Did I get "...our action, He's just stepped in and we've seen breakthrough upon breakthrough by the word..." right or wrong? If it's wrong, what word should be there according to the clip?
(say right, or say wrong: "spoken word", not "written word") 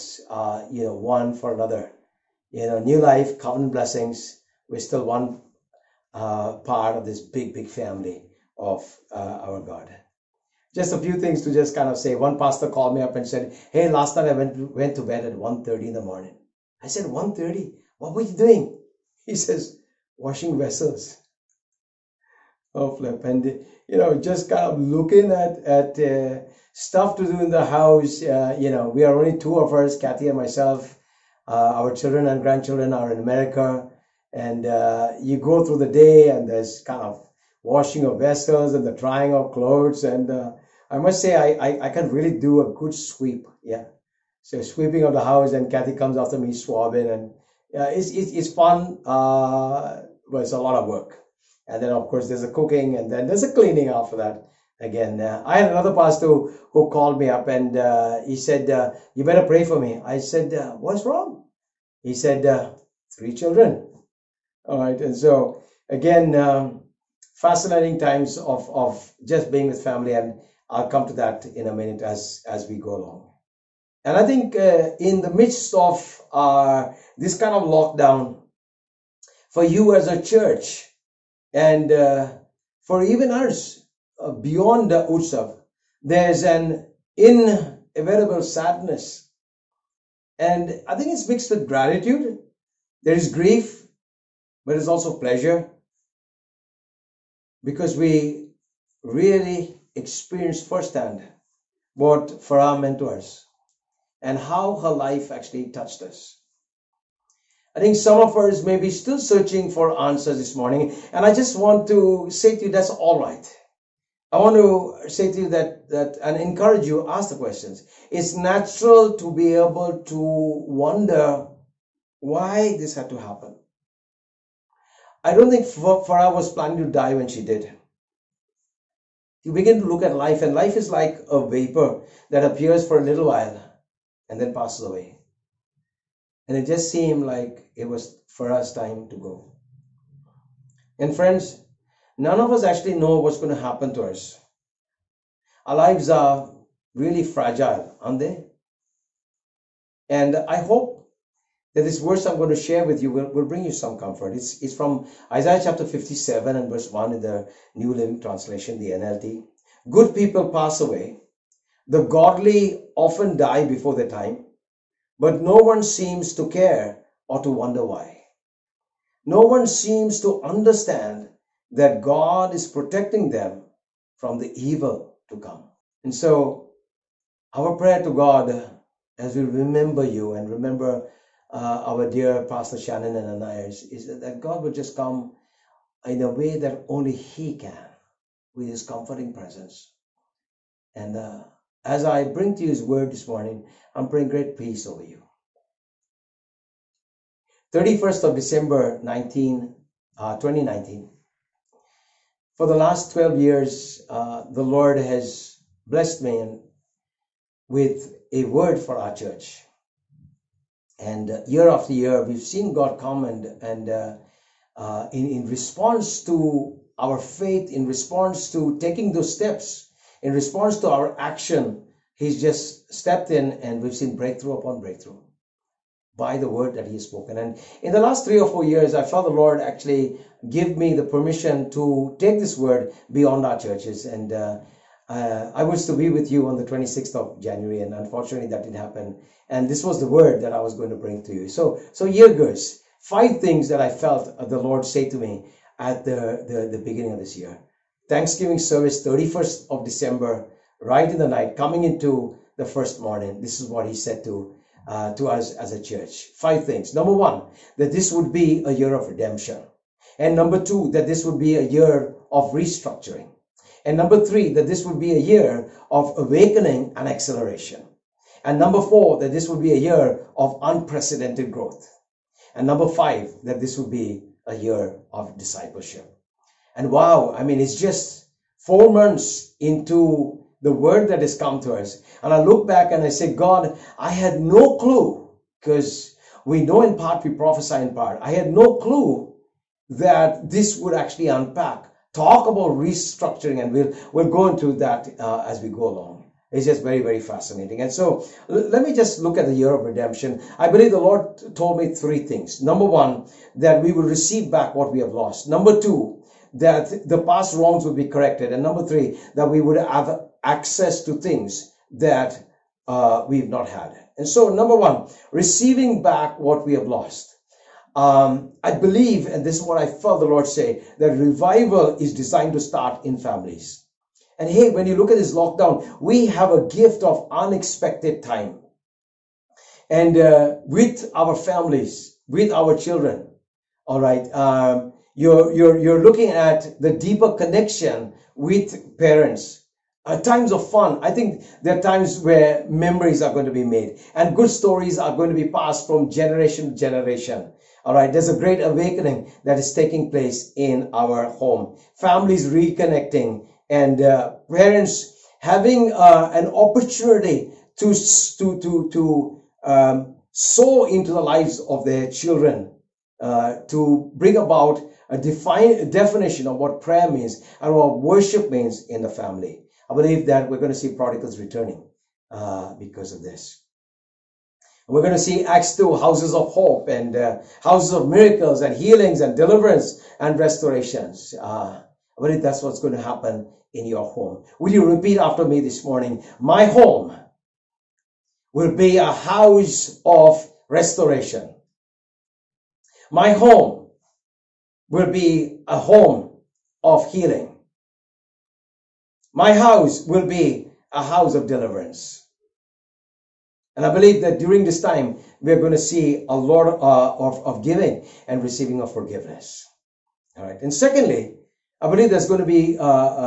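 right.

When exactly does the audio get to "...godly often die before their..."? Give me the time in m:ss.
2:42.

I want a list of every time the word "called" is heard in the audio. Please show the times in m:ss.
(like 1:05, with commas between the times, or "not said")
0:12, 0:56.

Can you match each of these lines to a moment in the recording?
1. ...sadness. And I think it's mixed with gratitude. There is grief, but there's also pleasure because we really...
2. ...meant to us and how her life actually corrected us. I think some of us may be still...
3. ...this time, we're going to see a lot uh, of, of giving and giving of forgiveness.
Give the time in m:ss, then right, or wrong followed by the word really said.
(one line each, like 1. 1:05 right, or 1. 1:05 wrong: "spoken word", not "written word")
1. 1:28 right
2. 1:42 wrong: "touched", not "corrected"
3. 6:44 wrong: "receiving", not "giving".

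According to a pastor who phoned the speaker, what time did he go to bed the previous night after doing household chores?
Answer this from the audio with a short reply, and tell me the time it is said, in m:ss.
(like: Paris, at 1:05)
1:30, at 0:15.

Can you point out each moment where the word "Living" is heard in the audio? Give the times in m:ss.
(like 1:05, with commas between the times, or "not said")
2:37.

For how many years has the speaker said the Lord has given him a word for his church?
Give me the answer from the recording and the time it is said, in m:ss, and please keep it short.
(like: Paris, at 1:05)
12, at 3:23.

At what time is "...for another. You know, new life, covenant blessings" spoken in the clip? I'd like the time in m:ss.
0:01.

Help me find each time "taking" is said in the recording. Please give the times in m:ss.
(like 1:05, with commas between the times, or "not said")
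3:38, 5:49.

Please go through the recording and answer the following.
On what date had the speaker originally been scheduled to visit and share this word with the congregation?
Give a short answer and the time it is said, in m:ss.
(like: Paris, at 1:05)
26th of January, at 3:56.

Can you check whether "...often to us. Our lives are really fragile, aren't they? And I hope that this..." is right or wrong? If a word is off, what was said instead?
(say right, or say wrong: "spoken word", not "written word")
wrong: "happen", not "often".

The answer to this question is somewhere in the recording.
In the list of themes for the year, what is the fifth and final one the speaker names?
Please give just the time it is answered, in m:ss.
4:35.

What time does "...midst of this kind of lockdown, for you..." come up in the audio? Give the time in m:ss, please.
1:15.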